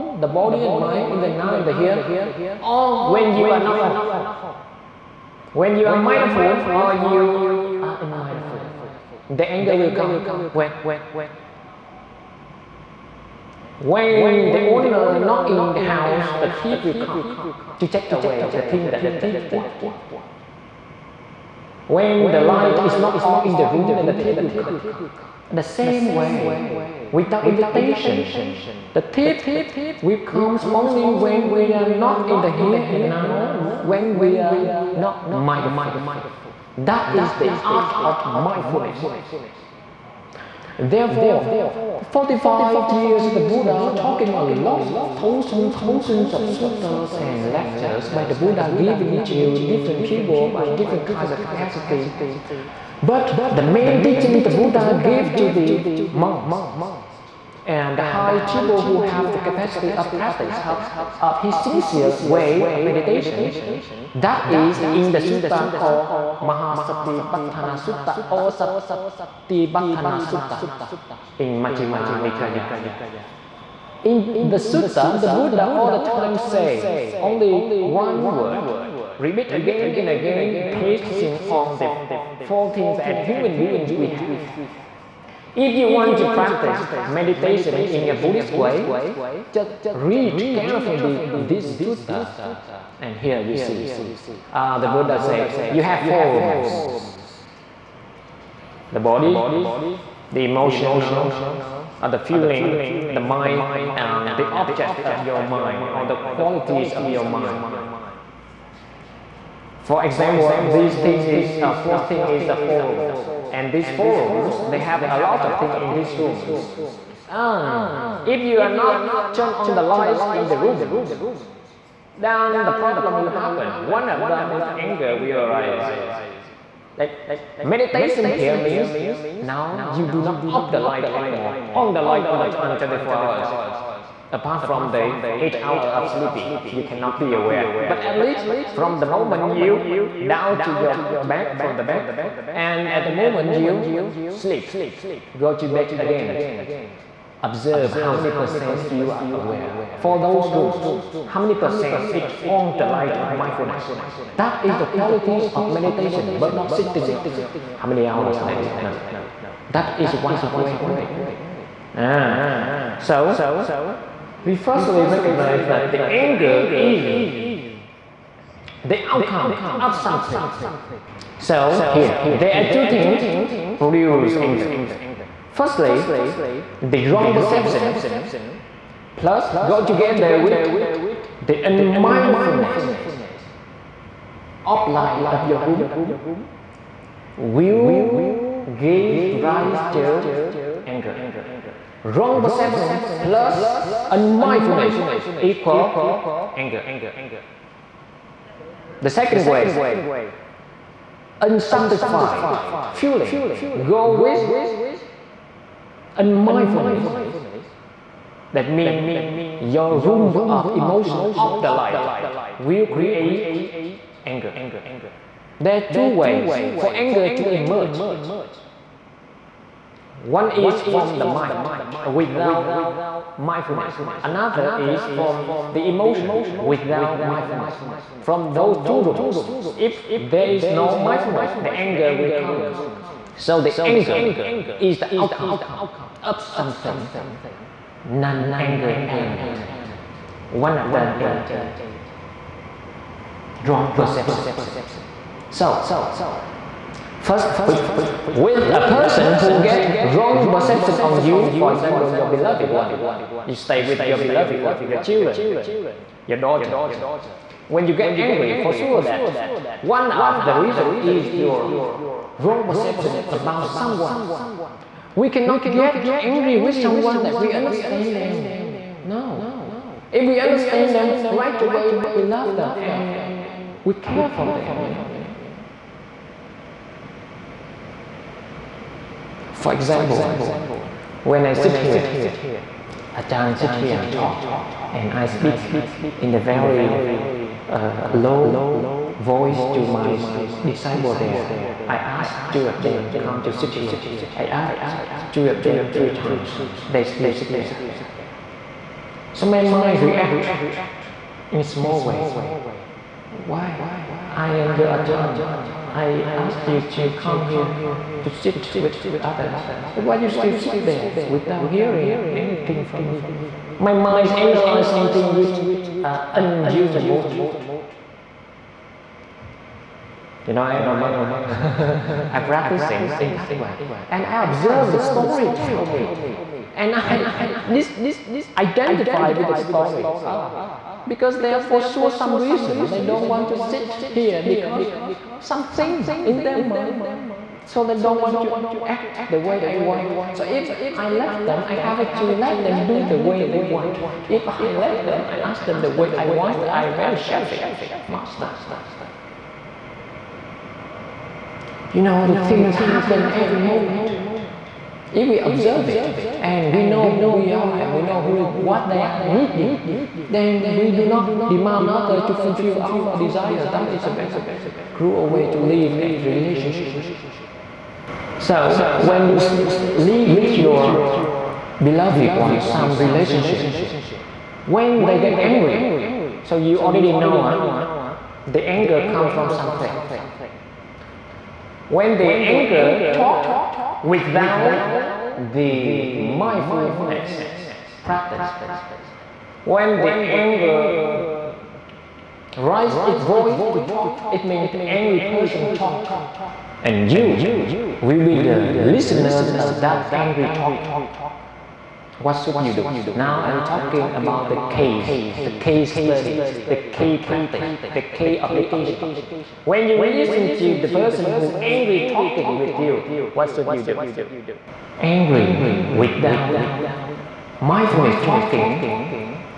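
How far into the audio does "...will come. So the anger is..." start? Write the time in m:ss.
3:52.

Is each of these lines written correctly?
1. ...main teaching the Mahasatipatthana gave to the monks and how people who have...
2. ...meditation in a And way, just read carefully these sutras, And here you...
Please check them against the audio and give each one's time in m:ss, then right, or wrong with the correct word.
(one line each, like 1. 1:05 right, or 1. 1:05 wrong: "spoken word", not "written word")
1. 0:53 wrong: "Buddha", not "Mahasatipatthana"
2. 1:27 wrong: "Buddhist", not "And".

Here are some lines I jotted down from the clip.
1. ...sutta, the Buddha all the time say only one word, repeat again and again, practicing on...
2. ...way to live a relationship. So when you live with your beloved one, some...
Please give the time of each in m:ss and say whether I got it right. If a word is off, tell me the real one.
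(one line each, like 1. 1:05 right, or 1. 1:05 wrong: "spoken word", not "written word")
1. 1:14 wrong: "pasting", not "practicing"
2. 6:05 right.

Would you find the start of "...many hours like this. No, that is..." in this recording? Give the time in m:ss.
2:37.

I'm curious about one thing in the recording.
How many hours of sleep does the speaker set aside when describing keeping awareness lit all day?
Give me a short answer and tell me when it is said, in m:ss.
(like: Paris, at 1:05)
8, at 2:15.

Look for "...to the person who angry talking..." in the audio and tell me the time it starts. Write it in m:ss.
6:50.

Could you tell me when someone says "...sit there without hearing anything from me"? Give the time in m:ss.
5:10.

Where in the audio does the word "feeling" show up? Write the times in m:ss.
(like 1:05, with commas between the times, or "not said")
1:42, 3:22.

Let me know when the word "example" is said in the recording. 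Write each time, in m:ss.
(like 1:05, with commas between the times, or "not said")
1:50, 4:11, 4:39.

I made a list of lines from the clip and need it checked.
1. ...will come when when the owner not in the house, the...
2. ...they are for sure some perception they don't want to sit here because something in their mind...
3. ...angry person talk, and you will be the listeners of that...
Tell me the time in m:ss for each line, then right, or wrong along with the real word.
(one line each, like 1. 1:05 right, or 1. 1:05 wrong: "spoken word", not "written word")
1. 0:09 right
2. 5:31 wrong: "reason", not "perception"
3. 6:34 right.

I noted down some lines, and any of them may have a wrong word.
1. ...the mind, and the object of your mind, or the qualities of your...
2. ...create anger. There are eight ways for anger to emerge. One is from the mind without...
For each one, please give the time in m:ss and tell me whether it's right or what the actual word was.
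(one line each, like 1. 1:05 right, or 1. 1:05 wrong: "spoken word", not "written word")
1. 1:43 right
2. 3:32 wrong: "two", not "eight".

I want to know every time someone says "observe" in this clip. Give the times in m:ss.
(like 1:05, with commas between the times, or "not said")
2:27, 5:24, 5:55.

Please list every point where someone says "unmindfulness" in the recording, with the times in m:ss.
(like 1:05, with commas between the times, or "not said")
3:01, 3:14, 3:26.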